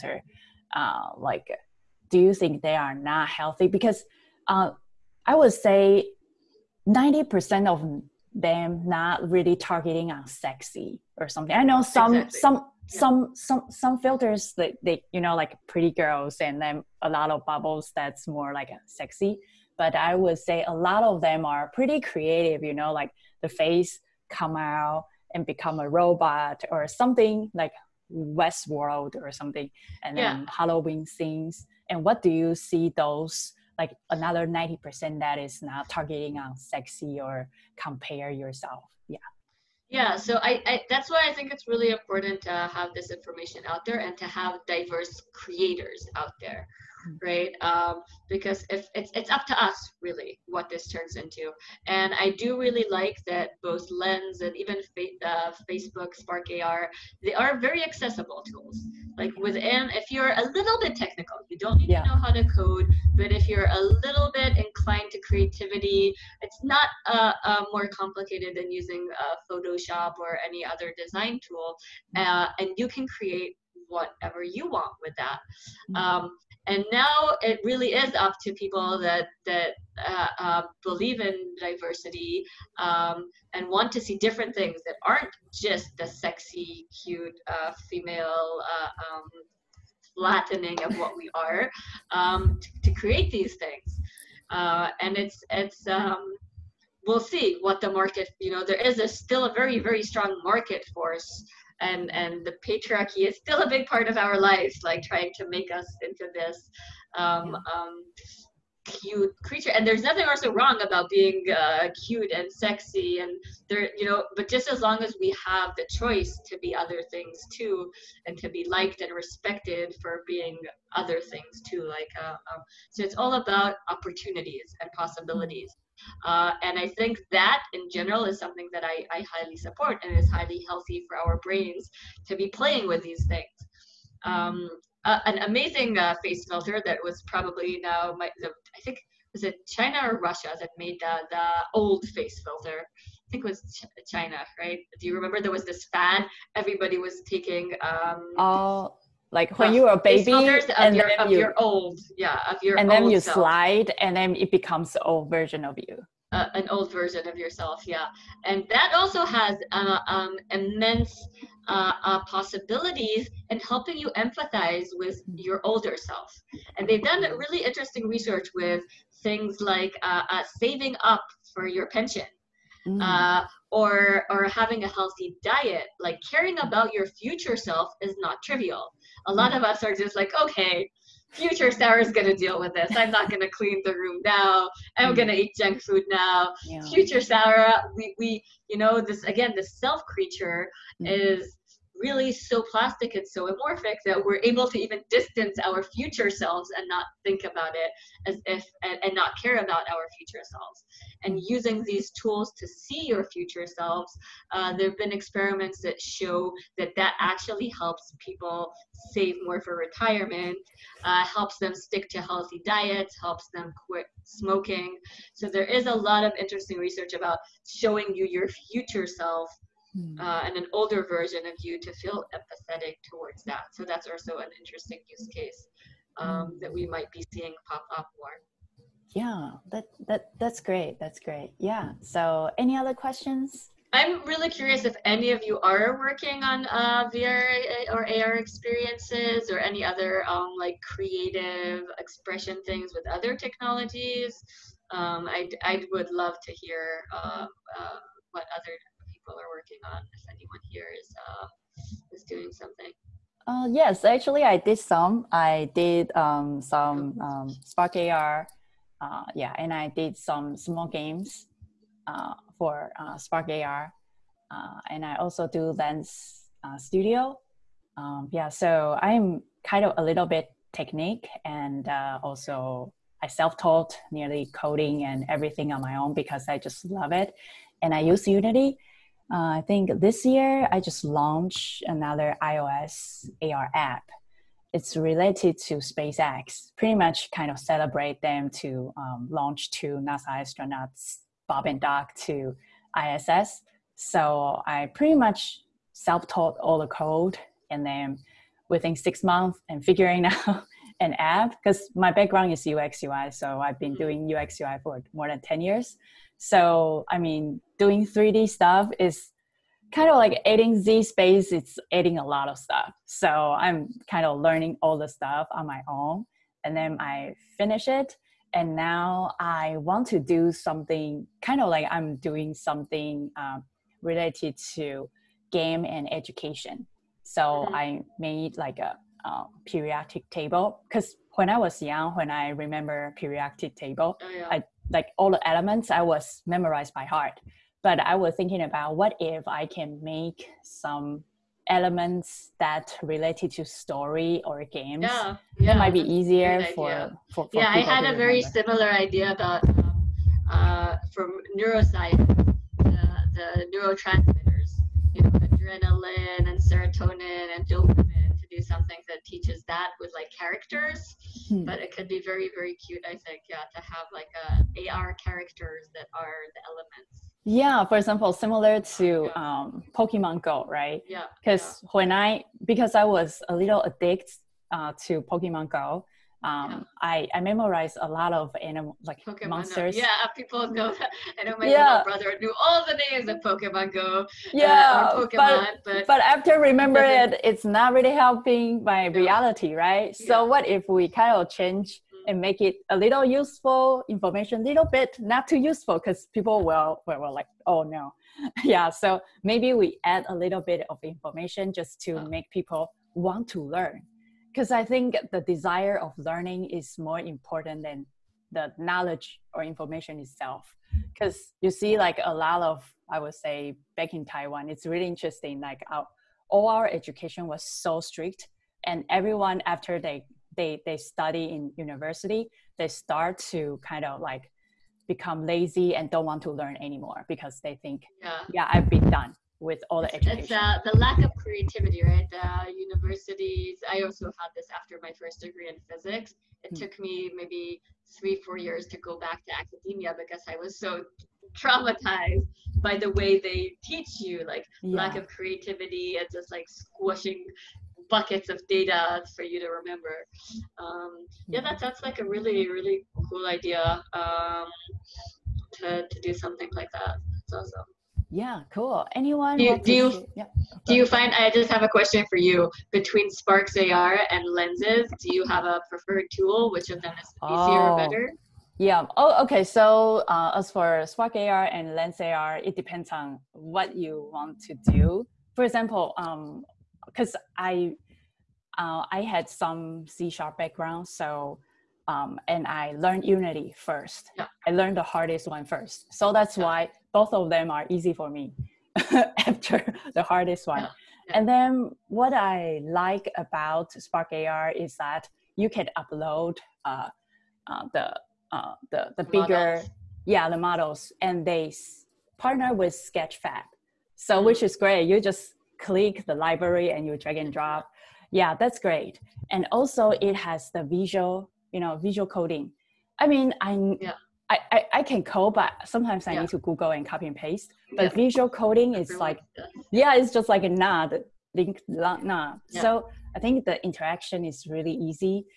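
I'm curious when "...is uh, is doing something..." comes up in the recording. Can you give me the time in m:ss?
4:10.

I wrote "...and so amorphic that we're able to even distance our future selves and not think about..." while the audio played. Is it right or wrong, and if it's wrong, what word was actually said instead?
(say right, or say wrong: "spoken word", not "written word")
right.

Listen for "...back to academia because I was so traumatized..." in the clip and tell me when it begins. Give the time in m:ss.
7:19.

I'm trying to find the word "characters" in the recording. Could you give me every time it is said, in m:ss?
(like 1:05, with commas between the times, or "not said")
6:00, 6:05.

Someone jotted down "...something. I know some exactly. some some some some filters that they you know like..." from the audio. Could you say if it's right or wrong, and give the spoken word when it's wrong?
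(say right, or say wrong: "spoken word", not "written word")
right.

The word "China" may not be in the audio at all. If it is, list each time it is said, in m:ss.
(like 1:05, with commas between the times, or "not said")
2:19, 2:24.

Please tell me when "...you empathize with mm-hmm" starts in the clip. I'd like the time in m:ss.
2:43.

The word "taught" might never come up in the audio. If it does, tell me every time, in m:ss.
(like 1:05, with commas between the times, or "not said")
4:33, 4:56.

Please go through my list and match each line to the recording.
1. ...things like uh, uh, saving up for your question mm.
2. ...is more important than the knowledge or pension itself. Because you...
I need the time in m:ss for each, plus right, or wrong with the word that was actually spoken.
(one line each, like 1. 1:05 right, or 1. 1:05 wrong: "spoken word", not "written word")
1. 2:49 wrong: "pension", not "question"
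2. 6:46 wrong: "information", not "pension".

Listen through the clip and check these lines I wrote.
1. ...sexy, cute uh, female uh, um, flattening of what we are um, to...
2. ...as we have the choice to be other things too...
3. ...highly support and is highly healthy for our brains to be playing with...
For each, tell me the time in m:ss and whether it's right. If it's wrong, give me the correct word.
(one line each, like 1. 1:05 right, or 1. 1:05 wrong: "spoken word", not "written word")
1. 1:26 right
2. 1:55 right
3. 2:09 right.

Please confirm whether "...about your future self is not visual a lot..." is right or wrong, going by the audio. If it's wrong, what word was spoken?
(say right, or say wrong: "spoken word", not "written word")
wrong: "trivial", not "visual".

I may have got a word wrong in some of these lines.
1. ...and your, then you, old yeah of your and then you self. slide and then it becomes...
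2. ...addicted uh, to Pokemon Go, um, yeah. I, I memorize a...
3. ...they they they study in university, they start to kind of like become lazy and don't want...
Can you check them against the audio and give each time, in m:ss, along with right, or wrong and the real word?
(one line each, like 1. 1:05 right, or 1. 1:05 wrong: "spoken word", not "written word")
1. 2:30 right
2. 6:13 right
3. 6:59 right.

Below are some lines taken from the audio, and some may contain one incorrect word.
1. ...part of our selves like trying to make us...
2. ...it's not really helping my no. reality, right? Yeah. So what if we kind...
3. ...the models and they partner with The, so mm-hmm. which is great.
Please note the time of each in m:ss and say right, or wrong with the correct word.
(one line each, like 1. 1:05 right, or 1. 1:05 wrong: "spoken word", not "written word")
1. 1:43 wrong: "lives", not "selves"
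2. 6:27 right
3. 8:20 wrong: "Sketchfab", not "The".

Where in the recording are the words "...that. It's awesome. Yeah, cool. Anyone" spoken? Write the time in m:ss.
7:36.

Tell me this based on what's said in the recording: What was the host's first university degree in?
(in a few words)
Physics.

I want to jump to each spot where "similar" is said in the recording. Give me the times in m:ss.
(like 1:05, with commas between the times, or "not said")
5:48, 6:08.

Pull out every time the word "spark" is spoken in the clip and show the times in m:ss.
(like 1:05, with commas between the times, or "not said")
0:56, 4:17, 4:23, 7:43, 7:51, 8:13.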